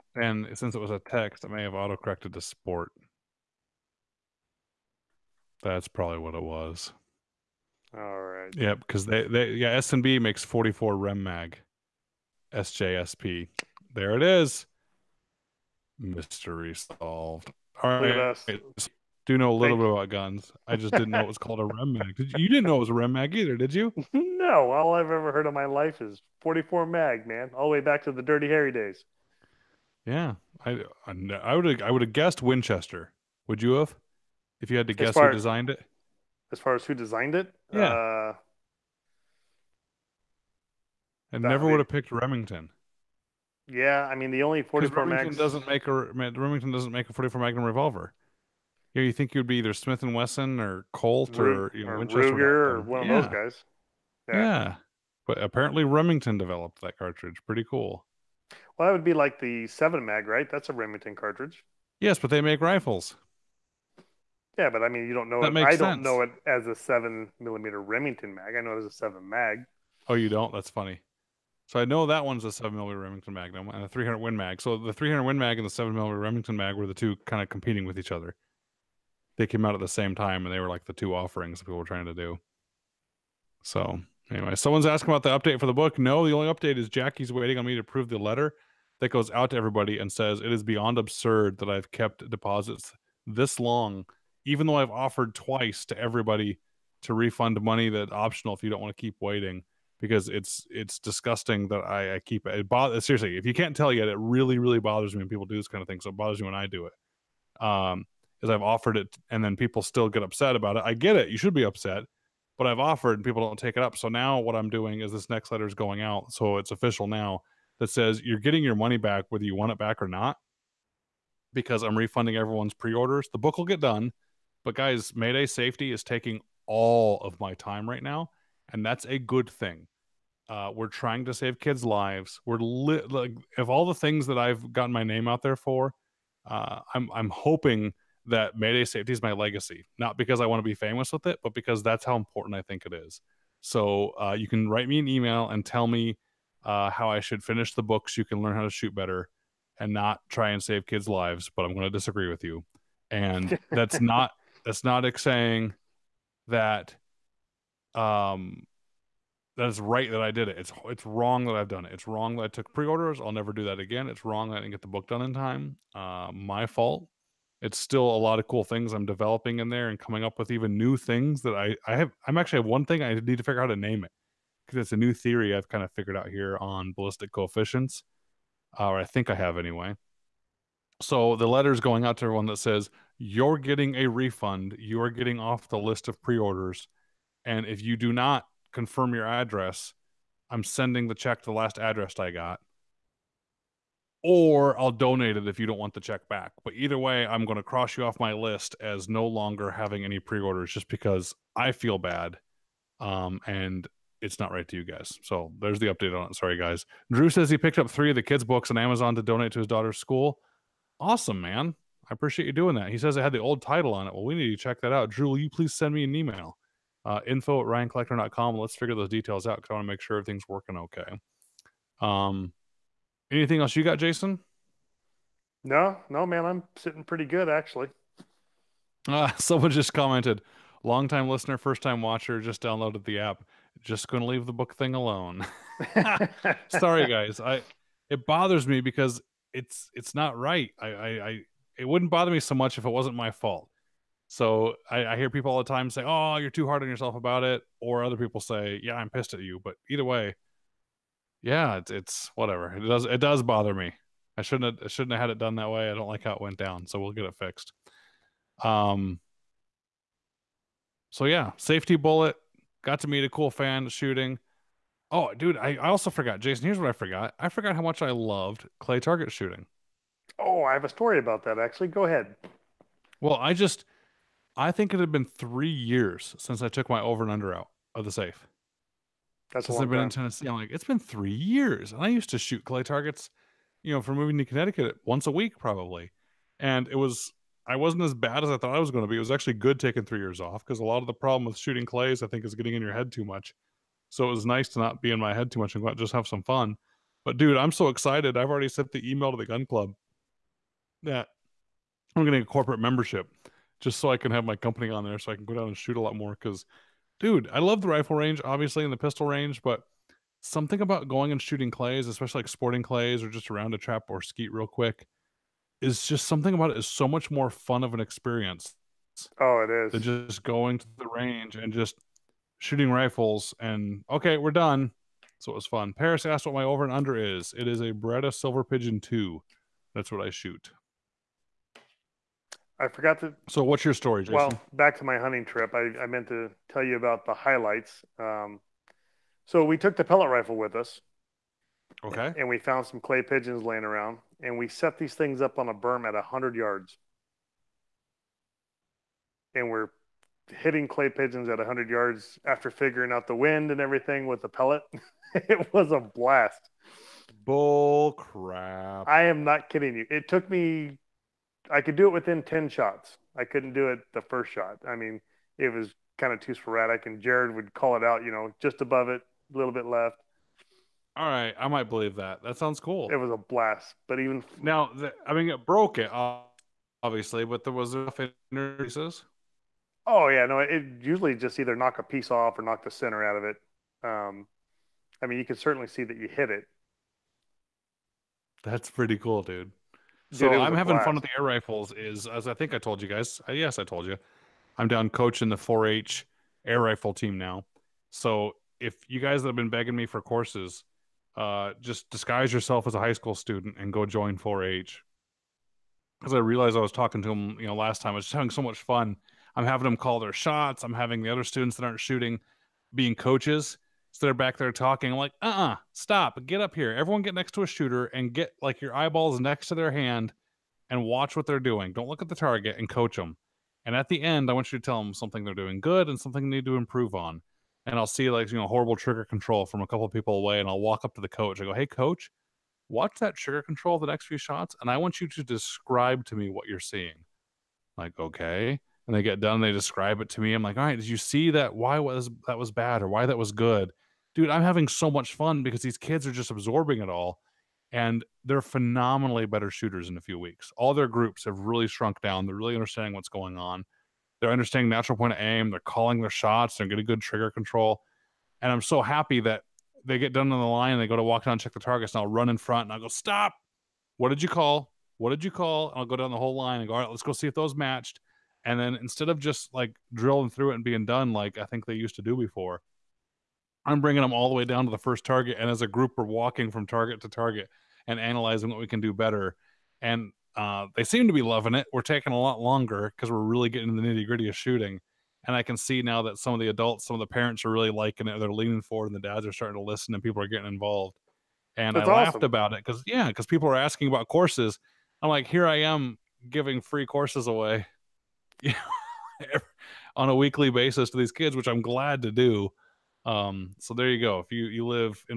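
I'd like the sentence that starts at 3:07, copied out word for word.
And if you do not confirm your address, I'm sending the check to the last address I got.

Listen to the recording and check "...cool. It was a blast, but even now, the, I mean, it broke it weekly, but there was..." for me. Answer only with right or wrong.
wrong.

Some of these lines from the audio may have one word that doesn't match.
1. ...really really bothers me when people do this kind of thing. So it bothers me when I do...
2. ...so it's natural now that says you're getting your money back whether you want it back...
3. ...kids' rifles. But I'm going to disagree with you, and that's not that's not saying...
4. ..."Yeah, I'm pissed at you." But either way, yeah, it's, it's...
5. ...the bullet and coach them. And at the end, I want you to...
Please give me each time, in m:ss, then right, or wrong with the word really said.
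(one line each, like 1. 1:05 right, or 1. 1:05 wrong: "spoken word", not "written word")
1. 1:44 right
2. 1:56 wrong: "official", not "natural"
3. 2:30 wrong: "lives", not "rifles"
4. 4:08 right
5. 7:02 wrong: "target", not "bullet".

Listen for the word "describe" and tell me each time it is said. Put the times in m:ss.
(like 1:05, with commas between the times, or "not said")
7:15, 7:19.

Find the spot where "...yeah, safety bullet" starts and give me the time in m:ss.
4:21.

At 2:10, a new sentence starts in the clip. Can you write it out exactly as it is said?
Uh, we're trying to save kids' lives.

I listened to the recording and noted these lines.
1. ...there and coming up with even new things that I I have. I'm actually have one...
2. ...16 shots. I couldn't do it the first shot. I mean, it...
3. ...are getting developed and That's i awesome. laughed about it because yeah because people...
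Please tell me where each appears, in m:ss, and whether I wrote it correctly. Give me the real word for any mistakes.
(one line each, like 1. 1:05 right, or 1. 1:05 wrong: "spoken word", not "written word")
1. 2:49 right
2. 6:02 wrong: "10", not "16"
3. 8:10 wrong: "involved", not "developed".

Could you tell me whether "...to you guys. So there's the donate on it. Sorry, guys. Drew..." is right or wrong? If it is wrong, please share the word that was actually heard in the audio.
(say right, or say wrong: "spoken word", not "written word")
wrong: "update", not "donate".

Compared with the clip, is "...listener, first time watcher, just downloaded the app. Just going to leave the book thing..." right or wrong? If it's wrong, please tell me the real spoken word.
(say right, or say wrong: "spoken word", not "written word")
right.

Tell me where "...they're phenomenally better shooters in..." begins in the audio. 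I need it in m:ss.
7:28.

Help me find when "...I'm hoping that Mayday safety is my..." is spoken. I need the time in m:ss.
2:17.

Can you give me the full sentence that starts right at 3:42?
Um, anything else you got, Jason?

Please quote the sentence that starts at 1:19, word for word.
They came out at the same time, and they were like the two offerings people were trying to do.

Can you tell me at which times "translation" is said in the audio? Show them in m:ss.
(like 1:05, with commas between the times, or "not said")
not said.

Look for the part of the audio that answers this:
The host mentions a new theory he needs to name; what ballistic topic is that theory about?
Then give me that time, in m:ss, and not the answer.
2:56.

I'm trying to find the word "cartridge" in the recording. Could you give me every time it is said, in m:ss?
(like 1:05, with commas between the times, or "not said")
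0:56, 1:01.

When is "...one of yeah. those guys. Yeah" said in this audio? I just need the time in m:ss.
0:52.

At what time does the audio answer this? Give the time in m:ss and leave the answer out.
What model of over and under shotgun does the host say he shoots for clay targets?
5:27.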